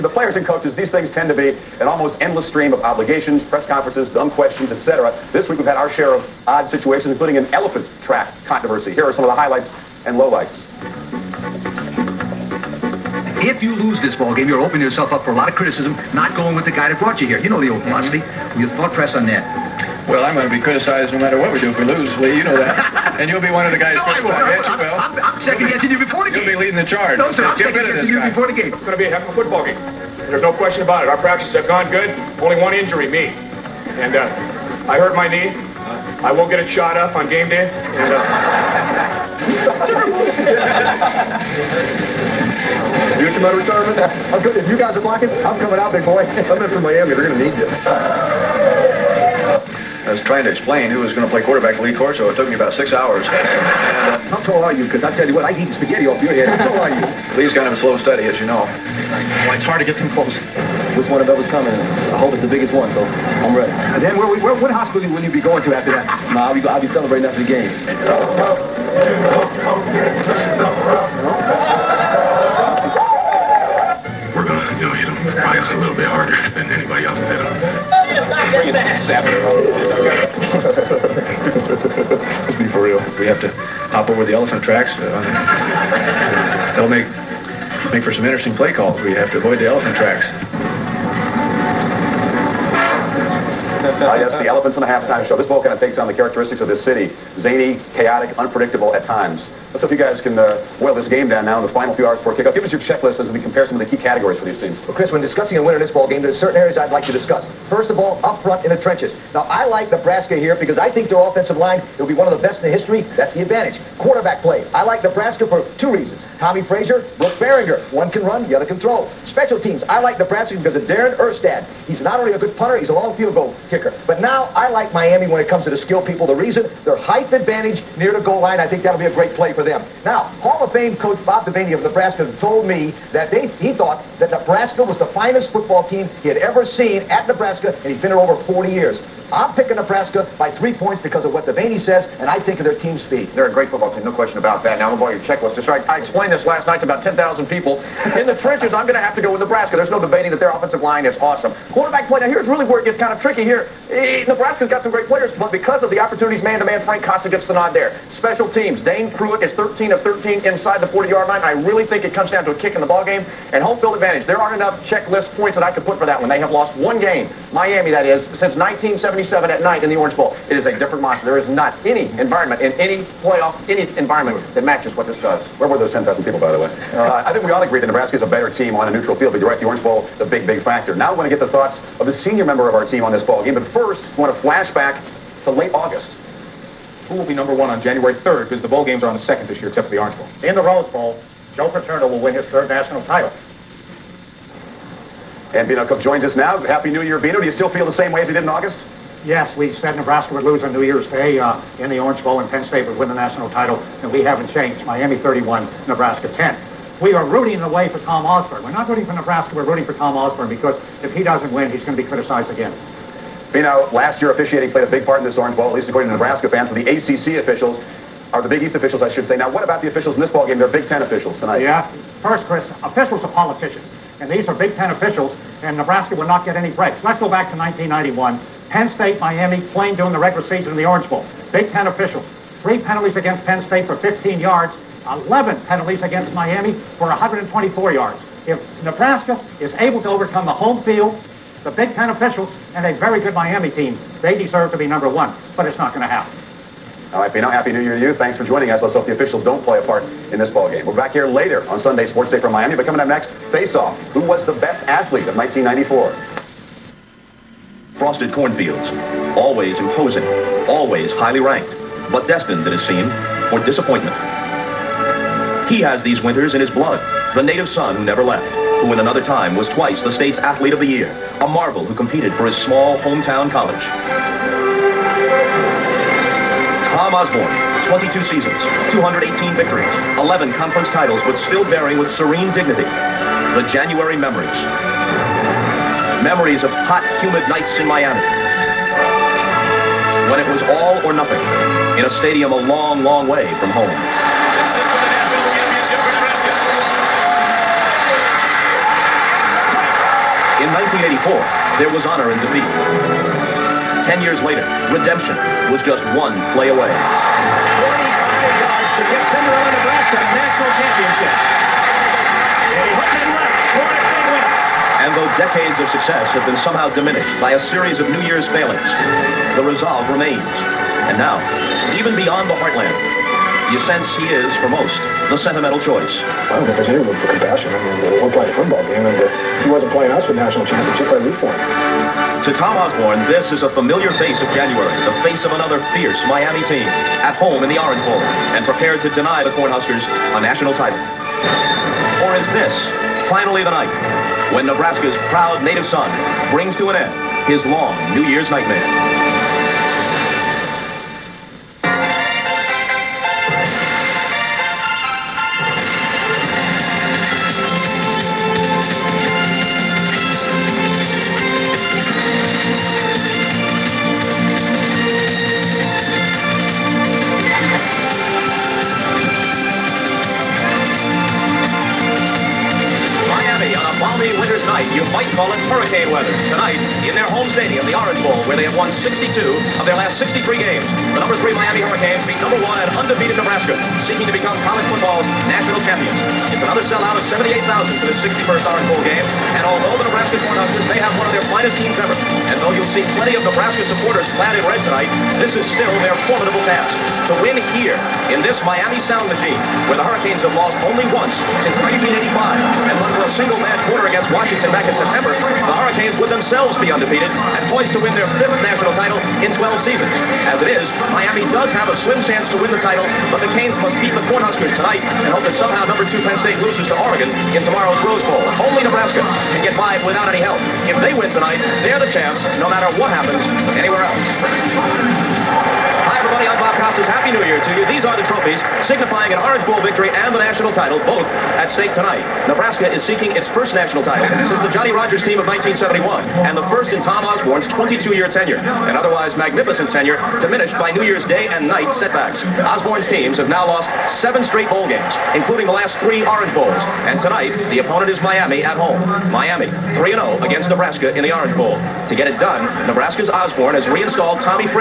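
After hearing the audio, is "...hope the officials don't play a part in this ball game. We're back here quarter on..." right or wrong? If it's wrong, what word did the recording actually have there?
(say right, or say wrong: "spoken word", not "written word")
wrong: "later", not "quarter".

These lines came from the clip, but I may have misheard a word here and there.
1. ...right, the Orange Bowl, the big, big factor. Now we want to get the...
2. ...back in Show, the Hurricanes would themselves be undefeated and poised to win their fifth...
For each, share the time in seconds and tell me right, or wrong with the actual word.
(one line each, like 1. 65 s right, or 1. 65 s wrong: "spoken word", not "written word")
1. 179 s right
2. 404 s wrong: "September", not "Show".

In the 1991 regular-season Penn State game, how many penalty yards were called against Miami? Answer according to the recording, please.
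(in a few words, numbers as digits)
124.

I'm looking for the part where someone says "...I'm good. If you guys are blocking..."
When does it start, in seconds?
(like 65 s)
44 s.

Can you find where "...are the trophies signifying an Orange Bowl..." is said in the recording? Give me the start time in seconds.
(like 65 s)
428 s.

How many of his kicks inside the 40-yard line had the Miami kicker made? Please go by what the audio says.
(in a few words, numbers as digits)
13 of 13.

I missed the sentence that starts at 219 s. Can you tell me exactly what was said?
Now, what about the officials in this ball game?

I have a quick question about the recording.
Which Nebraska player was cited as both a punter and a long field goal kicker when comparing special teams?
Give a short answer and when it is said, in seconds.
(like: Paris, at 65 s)
Darin Erstad, at 120 s.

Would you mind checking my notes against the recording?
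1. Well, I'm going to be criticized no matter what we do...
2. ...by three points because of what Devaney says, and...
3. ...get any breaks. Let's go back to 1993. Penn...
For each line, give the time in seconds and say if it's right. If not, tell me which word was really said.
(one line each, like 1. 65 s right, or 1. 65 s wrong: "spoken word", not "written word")
1. 20 s right
2. 140 s right
3. 226 s wrong: "1991", not "1993".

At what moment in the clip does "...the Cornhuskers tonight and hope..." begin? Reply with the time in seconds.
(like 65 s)
414 s.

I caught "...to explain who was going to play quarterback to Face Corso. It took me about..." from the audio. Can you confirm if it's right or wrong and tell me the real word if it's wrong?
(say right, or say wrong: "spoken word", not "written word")
wrong: "Lee", not "Face".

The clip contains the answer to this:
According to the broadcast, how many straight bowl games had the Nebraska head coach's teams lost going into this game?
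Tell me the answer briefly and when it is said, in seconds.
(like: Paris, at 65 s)
7, at 444 s.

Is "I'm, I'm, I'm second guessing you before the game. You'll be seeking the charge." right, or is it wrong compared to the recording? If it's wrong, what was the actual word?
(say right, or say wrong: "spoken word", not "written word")
wrong: "leading", not "seeking".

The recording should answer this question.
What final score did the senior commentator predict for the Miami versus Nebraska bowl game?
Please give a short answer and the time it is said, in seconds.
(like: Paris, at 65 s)
Miami 31, Nebraska 10, at 204 s.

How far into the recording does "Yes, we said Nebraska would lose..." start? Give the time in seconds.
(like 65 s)
199 s.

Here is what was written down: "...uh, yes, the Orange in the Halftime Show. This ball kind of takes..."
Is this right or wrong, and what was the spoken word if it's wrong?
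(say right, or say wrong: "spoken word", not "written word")
wrong: "Elephants", not "Orange".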